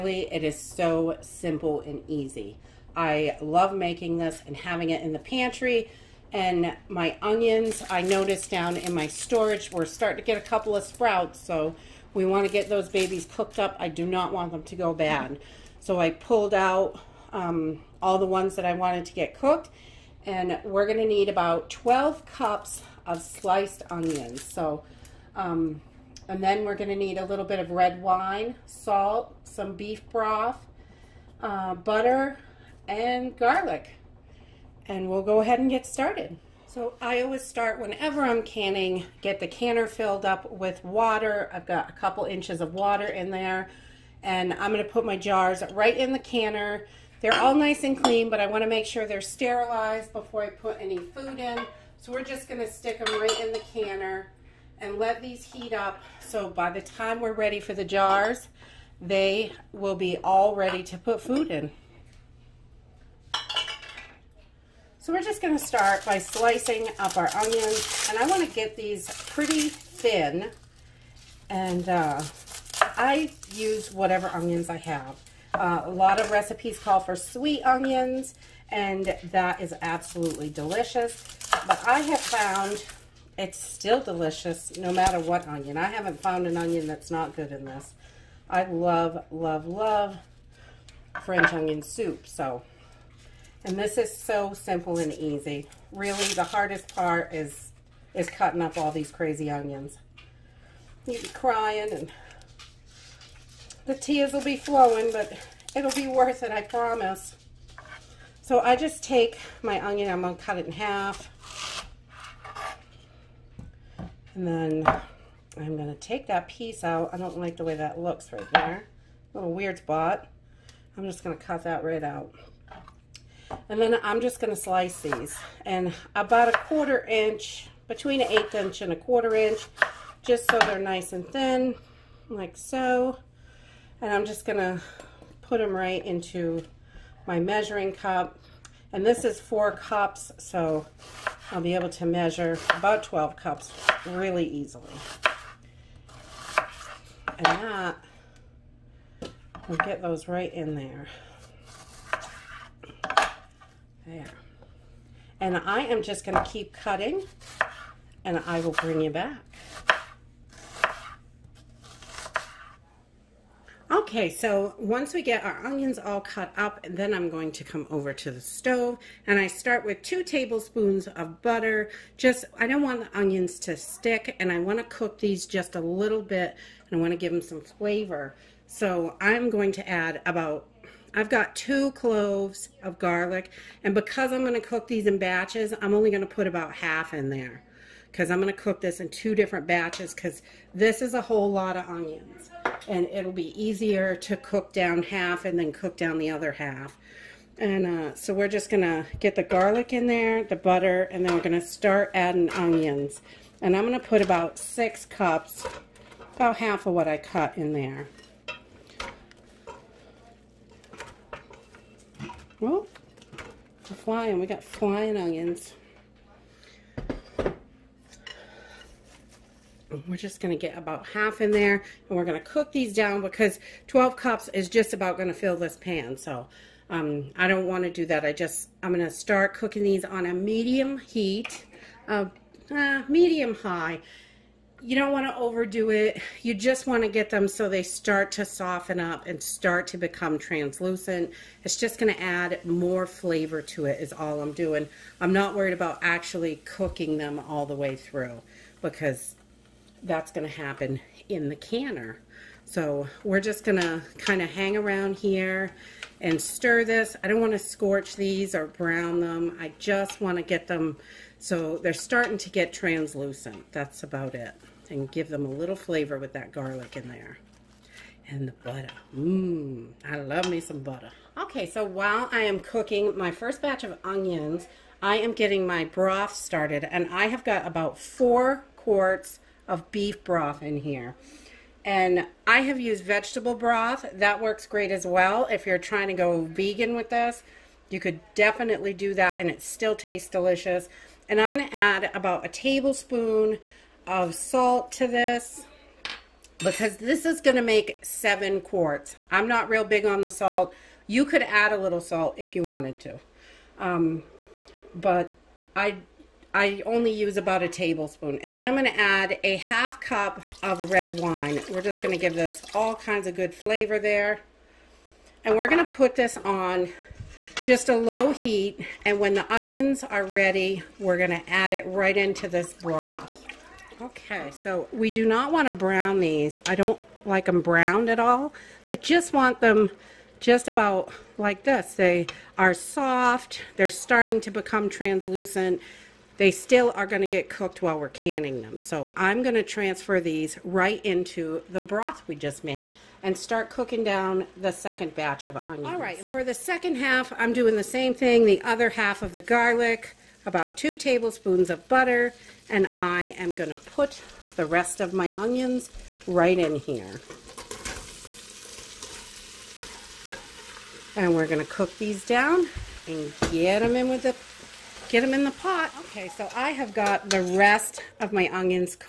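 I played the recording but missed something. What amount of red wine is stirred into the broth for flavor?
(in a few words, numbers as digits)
1/2 cup.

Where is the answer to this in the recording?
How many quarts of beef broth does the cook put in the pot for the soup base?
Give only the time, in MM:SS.
04:37.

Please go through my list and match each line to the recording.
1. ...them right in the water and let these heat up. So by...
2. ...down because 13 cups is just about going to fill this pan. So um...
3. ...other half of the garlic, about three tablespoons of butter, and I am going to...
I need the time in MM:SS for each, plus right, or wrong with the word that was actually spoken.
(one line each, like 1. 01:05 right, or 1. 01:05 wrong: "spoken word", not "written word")
1. 00:53 wrong: "canner", not "water"
2. 03:42 wrong: "12", not "13"
3. 05:48 wrong: "two", not "three".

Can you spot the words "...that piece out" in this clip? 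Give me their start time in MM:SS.
01:56.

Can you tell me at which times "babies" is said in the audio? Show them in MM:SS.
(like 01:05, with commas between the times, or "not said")
00:12.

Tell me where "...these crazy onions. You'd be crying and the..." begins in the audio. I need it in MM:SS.
01:38.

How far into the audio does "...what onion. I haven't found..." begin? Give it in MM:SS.
01:25.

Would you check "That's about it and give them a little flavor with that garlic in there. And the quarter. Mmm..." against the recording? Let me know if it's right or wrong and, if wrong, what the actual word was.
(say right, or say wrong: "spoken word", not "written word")
wrong: "butter", not "quarter".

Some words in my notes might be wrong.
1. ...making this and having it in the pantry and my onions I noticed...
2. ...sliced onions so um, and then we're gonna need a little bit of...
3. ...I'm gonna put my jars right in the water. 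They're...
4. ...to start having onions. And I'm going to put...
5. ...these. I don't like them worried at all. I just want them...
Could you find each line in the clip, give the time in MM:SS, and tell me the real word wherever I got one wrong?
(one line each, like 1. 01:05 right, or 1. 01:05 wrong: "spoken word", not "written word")
1. 00:03 right
2. 00:23 right
3. 00:44 wrong: "canner", not "water"
4. 03:21 wrong: "adding", not "having"
5. 05:26 wrong: "browned", not "worried".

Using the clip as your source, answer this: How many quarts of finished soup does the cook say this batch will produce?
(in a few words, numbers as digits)
7 quarts.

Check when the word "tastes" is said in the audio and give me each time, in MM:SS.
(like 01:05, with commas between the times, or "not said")
04:49.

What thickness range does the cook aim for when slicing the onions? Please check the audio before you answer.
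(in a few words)
1/8 to 1/4 inch.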